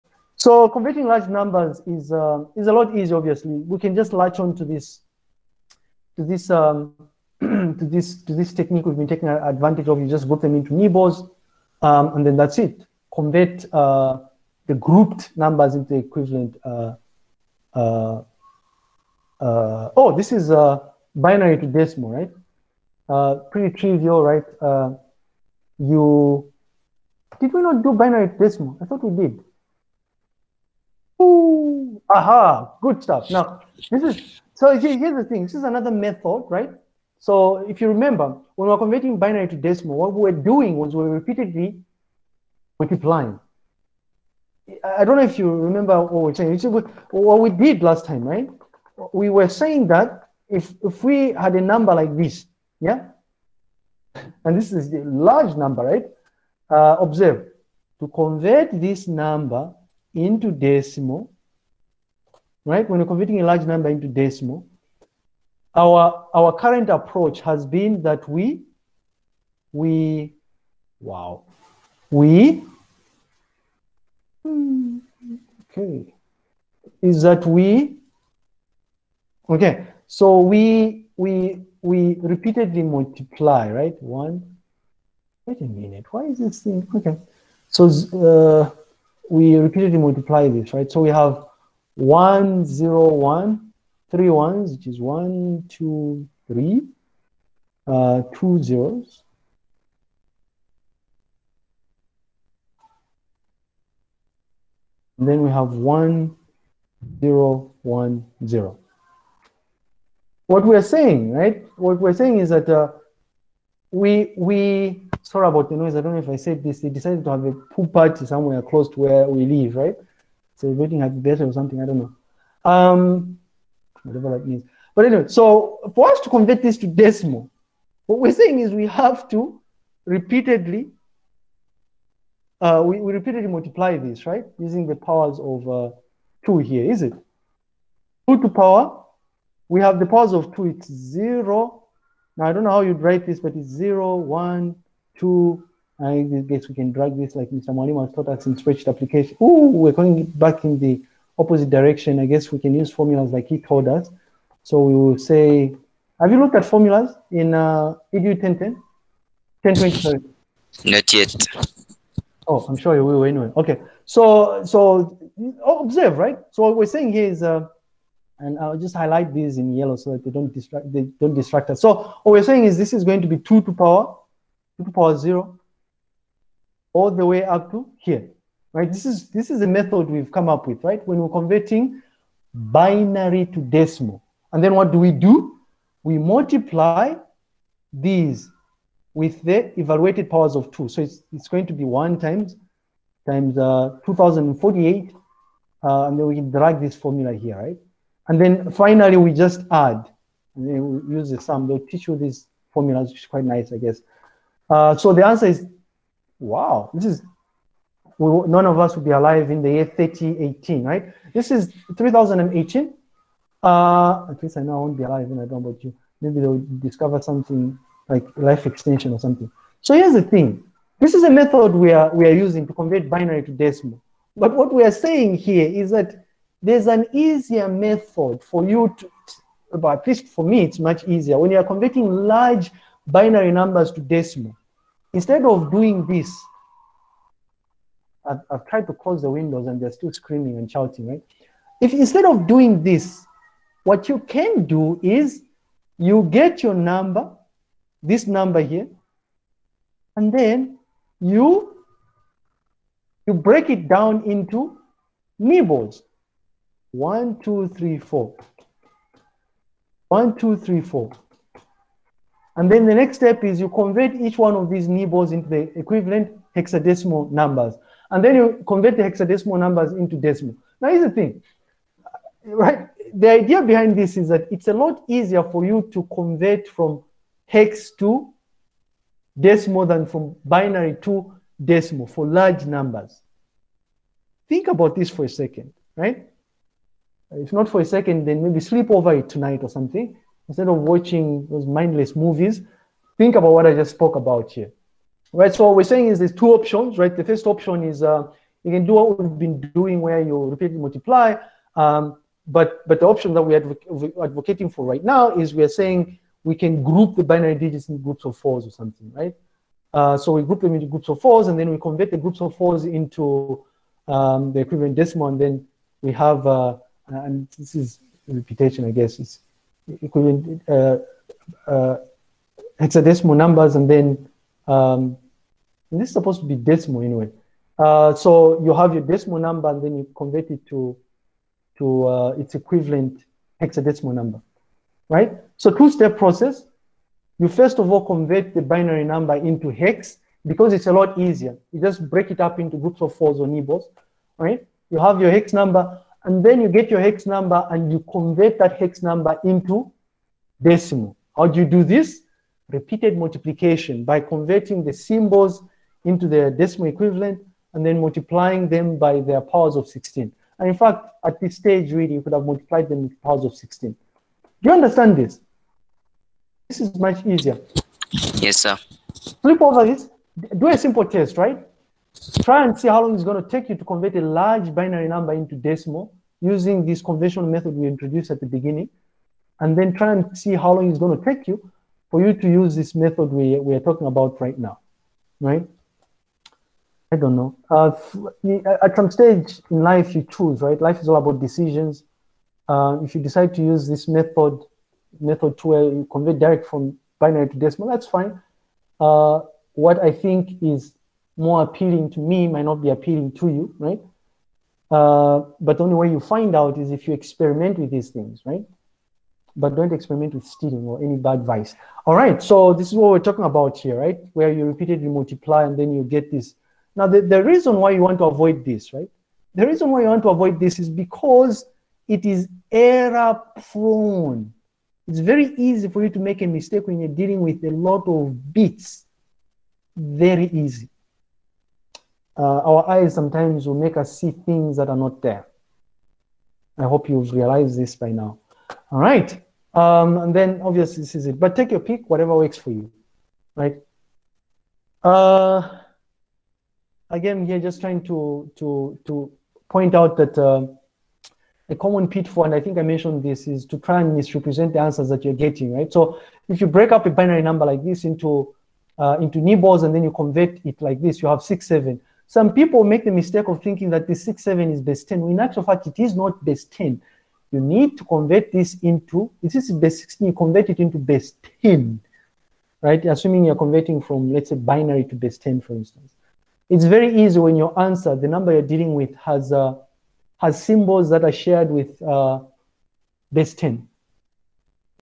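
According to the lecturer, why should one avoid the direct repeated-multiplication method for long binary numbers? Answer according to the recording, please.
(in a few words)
It is error prone.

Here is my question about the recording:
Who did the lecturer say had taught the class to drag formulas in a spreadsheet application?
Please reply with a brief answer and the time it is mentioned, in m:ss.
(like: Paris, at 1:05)
Mr. Mwalimu, at 2:27.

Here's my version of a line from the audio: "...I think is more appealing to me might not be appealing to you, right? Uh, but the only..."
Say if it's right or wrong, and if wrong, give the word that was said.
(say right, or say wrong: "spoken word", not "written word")
right.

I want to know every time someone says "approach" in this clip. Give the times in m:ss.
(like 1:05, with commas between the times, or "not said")
1:06.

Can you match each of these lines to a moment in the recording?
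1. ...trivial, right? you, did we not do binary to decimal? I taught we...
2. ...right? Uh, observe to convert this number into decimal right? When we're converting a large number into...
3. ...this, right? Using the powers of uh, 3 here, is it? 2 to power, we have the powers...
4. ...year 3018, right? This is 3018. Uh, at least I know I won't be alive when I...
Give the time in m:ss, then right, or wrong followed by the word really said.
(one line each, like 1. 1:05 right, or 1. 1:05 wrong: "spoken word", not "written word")
1. 0:23 wrong: "thought", not "taught"
2. 0:55 right
3. 2:13 wrong: "2", not "3"
4. 3:29 right.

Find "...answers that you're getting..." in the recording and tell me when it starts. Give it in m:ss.
7:34.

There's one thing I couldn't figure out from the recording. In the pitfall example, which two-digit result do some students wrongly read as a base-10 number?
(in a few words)
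67.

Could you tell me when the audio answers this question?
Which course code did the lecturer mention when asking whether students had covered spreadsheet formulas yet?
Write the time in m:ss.
2:38.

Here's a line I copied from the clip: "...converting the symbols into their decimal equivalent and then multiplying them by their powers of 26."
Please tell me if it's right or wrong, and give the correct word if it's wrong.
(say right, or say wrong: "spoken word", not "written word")
wrong: "16", not "26".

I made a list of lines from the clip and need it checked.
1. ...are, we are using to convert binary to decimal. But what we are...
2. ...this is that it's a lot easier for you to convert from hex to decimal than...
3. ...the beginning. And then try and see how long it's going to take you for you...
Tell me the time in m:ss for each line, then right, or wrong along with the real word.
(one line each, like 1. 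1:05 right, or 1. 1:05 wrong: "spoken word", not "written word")
1. 3:41 right
2. 4:33 right
3. 6:18 right.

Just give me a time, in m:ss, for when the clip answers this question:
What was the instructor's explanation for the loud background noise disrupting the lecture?
1:57.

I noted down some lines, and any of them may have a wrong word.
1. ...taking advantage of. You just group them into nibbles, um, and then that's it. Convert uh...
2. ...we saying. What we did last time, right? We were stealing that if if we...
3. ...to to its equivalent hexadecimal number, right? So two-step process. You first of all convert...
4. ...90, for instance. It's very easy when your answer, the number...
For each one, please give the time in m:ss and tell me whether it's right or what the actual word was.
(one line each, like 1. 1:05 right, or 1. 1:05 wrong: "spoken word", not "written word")
1. 0:09 right
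2. 0:46 wrong: "saying", not "stealing"
3. 5:30 right
4. 7:55 wrong: "10", not "90".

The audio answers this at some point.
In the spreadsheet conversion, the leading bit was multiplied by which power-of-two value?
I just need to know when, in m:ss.
3:14.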